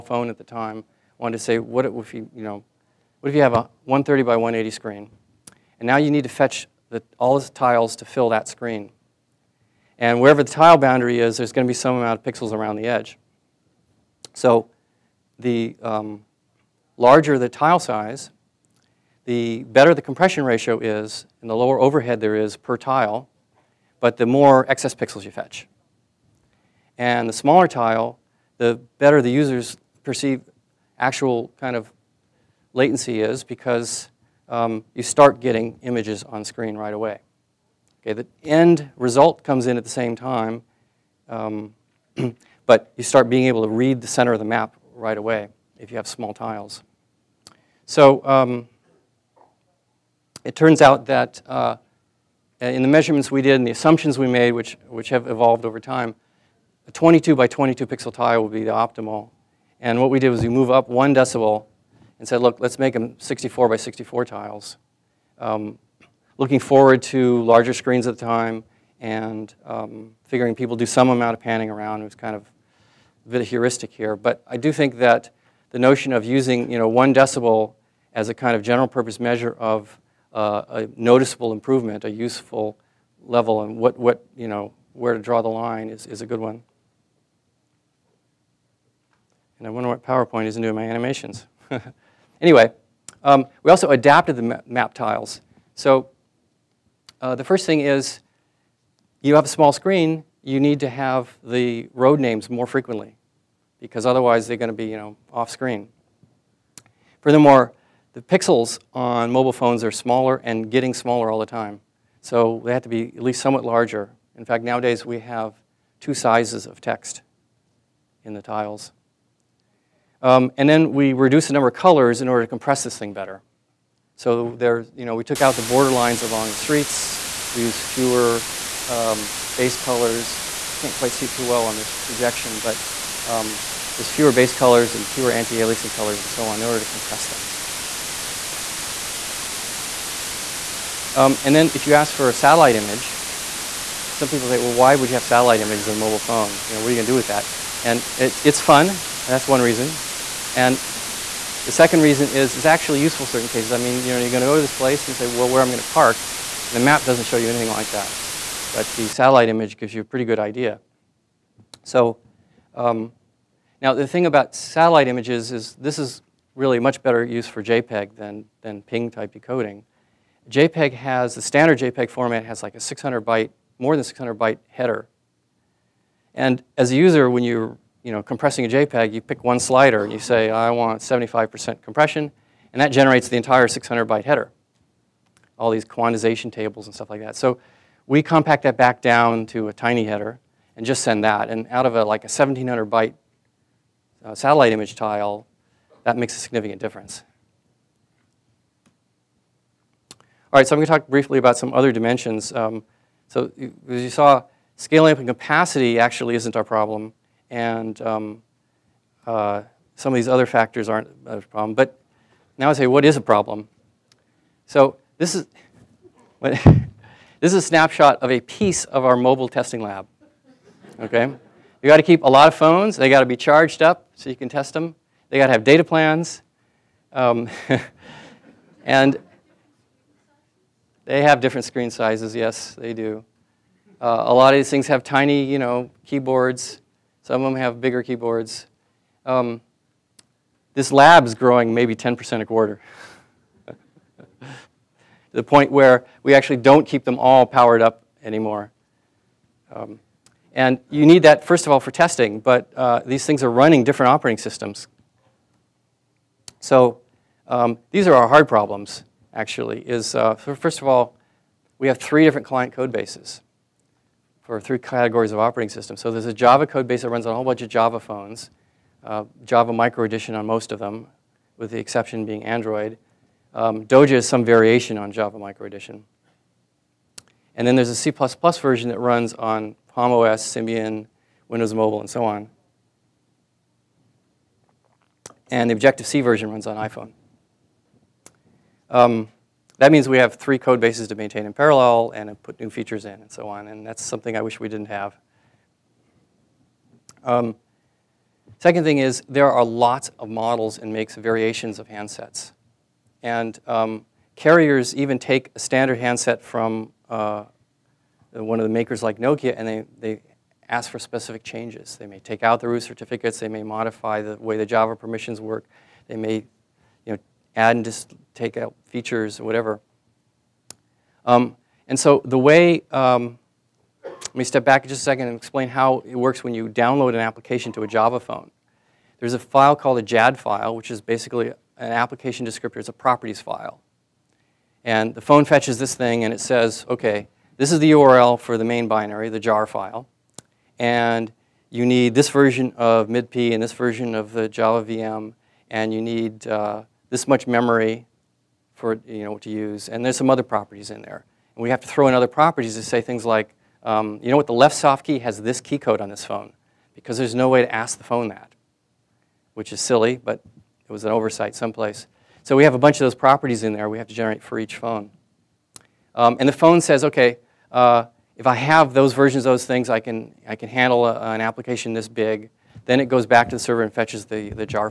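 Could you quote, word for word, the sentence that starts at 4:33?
Um, Doja is some variation on Java Micro Edition.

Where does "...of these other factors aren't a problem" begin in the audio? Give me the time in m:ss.
3:30.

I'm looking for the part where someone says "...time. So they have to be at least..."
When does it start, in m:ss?
1:51.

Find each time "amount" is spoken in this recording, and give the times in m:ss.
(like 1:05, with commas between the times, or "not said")
0:11, 1:11.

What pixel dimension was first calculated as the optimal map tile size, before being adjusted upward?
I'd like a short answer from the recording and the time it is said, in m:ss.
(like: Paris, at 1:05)
22 by 22, at 0:56.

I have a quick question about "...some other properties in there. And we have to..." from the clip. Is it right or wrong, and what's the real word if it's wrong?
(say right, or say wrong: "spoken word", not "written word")
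right.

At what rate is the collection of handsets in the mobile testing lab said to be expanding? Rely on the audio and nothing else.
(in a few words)
10% a quarter.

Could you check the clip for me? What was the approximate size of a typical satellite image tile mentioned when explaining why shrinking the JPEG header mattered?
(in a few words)
1700 bytes.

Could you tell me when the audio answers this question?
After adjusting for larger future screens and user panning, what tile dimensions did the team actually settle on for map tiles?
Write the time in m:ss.
1:03.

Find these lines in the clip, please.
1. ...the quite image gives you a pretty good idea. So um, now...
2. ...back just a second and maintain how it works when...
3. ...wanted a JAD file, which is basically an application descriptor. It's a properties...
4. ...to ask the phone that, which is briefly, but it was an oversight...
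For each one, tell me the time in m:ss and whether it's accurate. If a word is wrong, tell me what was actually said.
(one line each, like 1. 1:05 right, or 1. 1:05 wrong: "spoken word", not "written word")
1. 2:38 wrong: "satellite", not "quite"
2. 5:24 wrong: "explain", not "maintain"
3. 5:29 wrong: "called", not "wanted"
4. 5:57 wrong: "silly", not "briefly".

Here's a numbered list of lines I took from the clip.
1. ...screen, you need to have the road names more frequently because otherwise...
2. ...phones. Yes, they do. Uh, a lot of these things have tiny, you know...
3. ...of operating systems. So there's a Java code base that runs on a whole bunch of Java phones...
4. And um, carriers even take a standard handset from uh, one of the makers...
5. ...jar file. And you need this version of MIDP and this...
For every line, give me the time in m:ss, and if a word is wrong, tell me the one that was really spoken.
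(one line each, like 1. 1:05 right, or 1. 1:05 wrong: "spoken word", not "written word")
1. 1:39 right
2. 3:51 wrong: "sizes", not "phones"
3. 4:25 right
4. 5:03 right
5. 5:39 right.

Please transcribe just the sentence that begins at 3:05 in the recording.
All these quantization tables and stuff like that.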